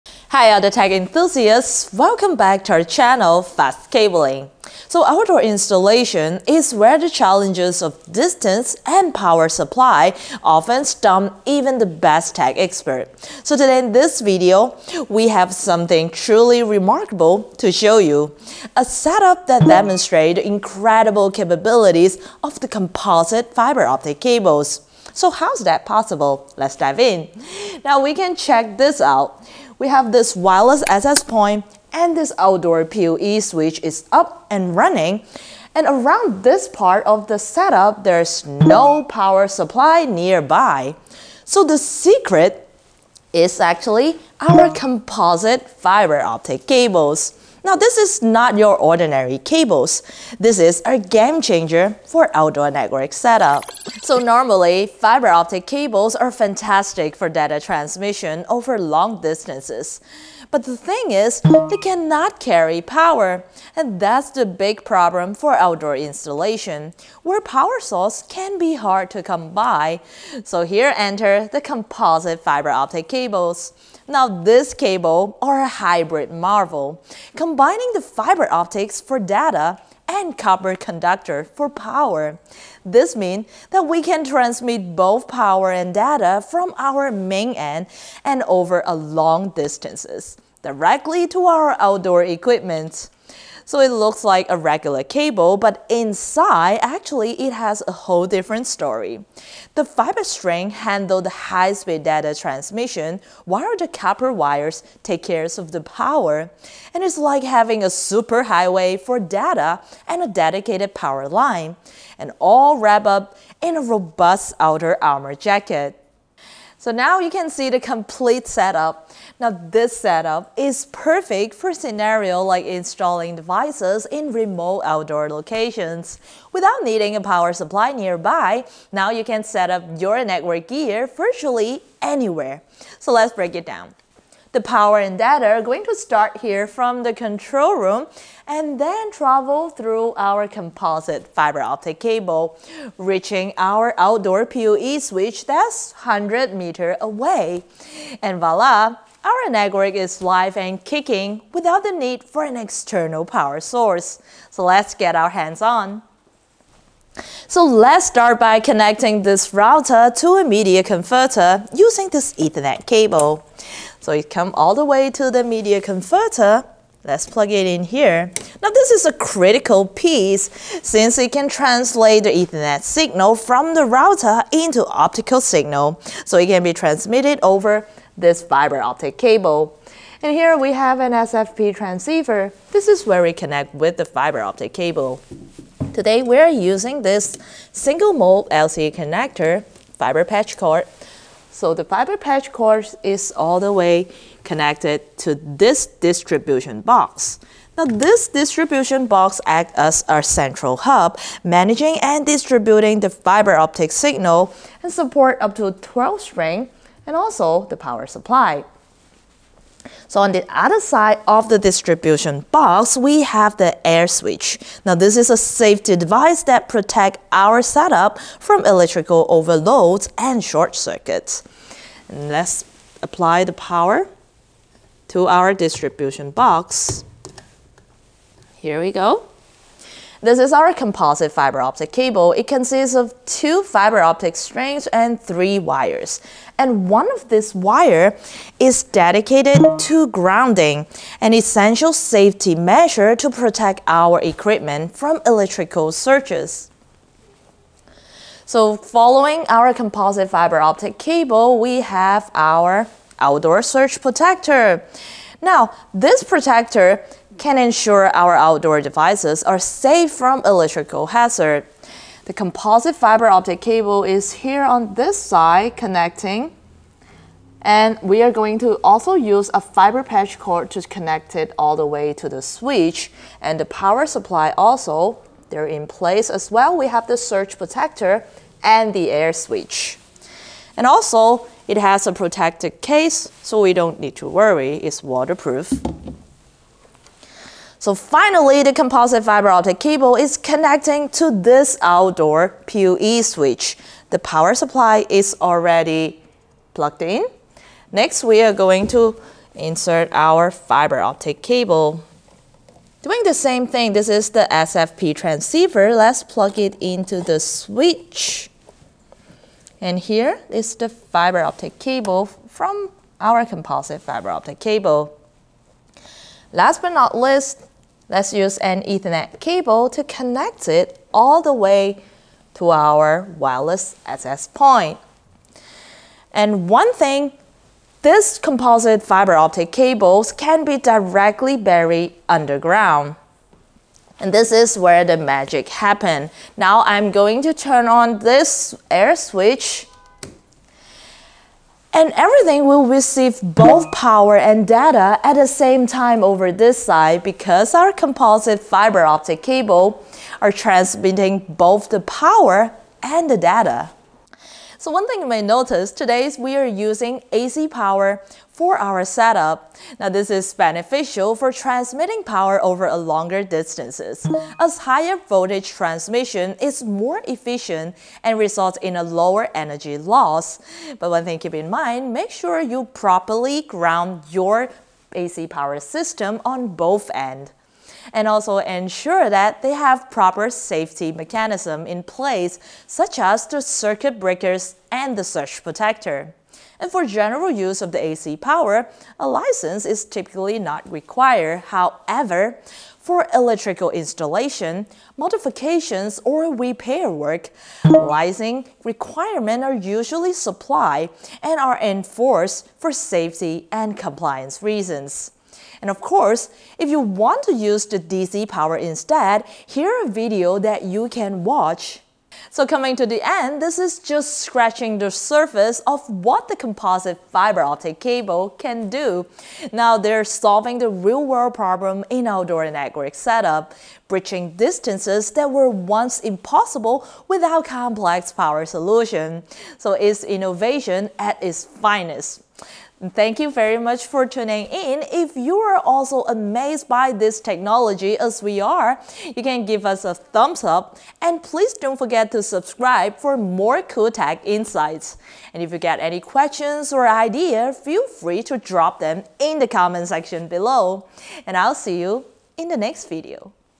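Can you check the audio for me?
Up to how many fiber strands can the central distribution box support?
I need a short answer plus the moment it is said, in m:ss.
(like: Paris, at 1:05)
12, at 3:25.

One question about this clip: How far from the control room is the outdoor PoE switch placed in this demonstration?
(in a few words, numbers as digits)
100 meters.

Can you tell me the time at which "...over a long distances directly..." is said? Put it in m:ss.
1:28.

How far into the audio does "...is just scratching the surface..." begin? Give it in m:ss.
6:53.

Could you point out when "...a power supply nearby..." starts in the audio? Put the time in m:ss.
2:07.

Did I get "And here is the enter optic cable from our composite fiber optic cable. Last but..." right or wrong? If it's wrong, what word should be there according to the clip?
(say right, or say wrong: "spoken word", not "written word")
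wrong: "fiber", not "enter".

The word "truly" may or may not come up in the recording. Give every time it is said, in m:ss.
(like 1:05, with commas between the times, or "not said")
0:16.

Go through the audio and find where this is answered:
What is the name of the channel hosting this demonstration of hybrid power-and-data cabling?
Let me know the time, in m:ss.
0:03.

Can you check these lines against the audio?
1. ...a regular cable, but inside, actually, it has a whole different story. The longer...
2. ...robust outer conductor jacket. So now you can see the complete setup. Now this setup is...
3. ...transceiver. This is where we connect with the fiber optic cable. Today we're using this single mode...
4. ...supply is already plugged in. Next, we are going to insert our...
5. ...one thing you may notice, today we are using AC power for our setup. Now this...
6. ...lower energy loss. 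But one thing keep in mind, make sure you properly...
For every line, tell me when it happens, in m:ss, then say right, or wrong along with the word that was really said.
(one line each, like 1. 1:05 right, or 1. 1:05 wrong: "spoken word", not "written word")
1. 1:34 wrong: "fiber", not "longer"
2. 1:53 wrong: "armor", not "conductor"
3. 3:01 right
4. 4:54 right
5. 5:54 right
6. 6:09 right.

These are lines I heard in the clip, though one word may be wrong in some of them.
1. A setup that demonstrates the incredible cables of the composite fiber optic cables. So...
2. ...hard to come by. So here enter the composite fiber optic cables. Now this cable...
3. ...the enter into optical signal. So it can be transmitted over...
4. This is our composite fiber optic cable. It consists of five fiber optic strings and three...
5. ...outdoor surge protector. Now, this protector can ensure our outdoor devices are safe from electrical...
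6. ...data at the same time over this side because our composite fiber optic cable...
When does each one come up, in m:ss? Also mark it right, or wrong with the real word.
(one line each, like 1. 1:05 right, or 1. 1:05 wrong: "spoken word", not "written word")
1. 0:18 wrong: "capabilities", not "cables"
2. 1:08 right
3. 2:53 wrong: "router", not "enter"
4. 3:50 wrong: "two", not "five"
5. 4:13 right
6. 5:44 right.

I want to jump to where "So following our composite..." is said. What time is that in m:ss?
4:08.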